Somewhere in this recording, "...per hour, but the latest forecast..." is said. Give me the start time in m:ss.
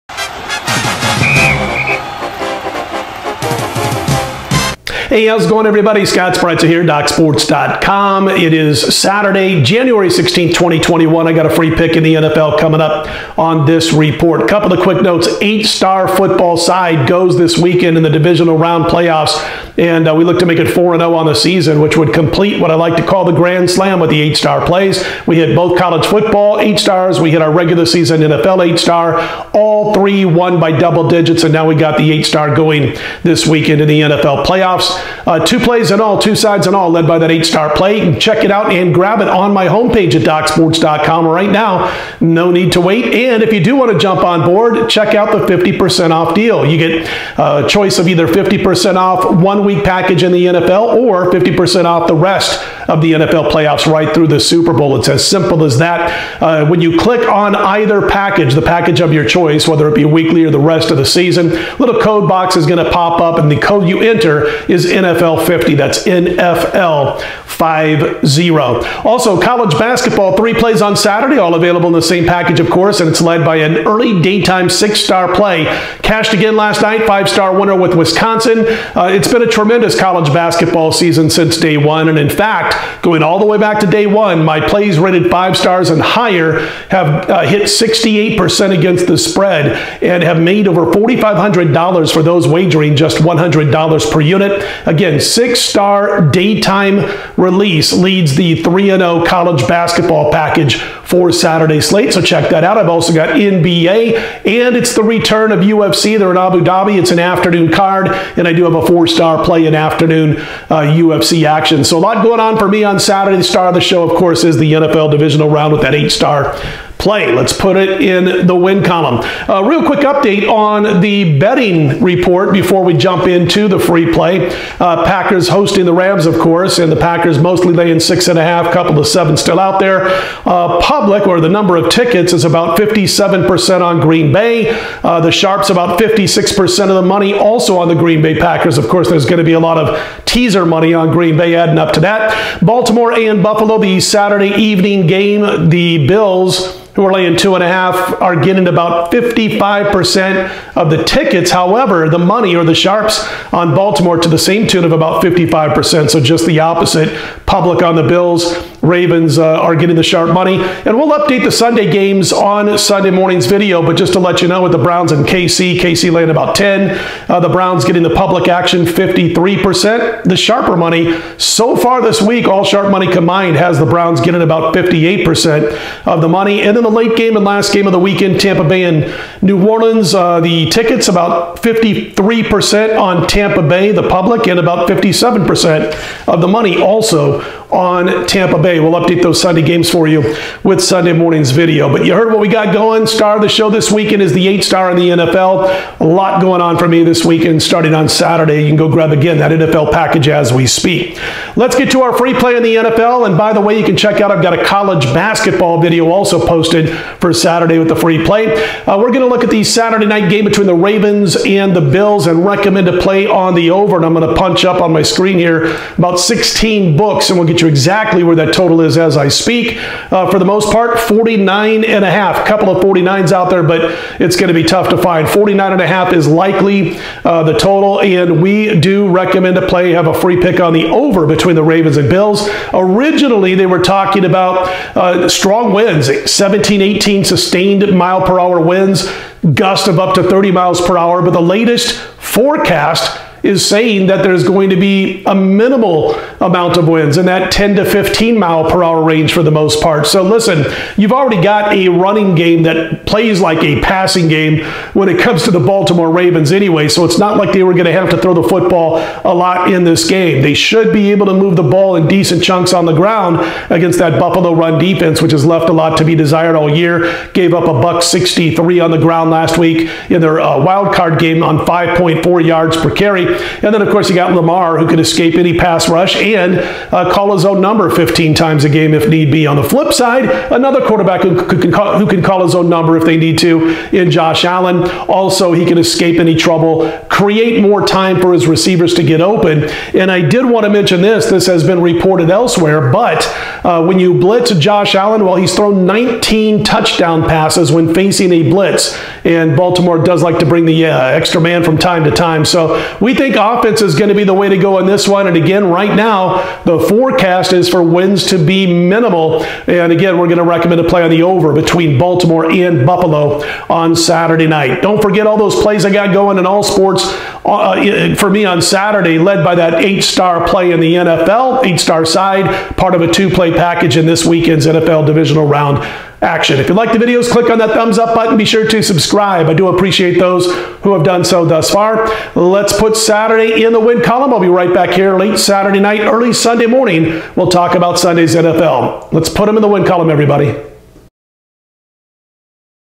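4:00.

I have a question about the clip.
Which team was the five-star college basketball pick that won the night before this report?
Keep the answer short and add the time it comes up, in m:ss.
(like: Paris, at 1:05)
Wisconsin, at 1:17.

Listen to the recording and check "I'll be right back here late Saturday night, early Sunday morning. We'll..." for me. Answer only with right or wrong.
right.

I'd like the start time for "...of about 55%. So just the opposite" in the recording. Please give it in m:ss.
2:34.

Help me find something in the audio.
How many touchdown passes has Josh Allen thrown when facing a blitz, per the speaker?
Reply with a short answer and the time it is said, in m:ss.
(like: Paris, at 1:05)
19, at 4:55.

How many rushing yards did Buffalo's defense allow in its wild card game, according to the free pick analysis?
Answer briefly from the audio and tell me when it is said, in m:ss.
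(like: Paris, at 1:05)
163, at 4:27.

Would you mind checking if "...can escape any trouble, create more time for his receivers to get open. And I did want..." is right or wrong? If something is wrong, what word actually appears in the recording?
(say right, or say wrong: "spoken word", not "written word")
right.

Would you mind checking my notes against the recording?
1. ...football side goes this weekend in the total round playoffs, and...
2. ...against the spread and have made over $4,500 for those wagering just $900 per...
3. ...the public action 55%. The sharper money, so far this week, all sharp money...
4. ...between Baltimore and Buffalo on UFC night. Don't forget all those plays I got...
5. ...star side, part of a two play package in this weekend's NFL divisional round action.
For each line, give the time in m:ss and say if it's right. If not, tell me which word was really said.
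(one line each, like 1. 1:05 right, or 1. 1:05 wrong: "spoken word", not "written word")
1. 0:16 wrong: "divisional", not "total"
2. 1:28 wrong: "100", not "900"
3. 2:48 wrong: "53", not "55"
4. 5:11 wrong: "Saturday", not "UFC"
5. 5:21 right.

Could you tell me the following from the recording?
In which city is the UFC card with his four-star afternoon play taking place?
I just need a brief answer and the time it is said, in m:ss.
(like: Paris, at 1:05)
Abu Dhabi, at 1:46.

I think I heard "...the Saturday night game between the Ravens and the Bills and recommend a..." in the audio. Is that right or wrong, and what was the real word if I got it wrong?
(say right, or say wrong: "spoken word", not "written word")
right.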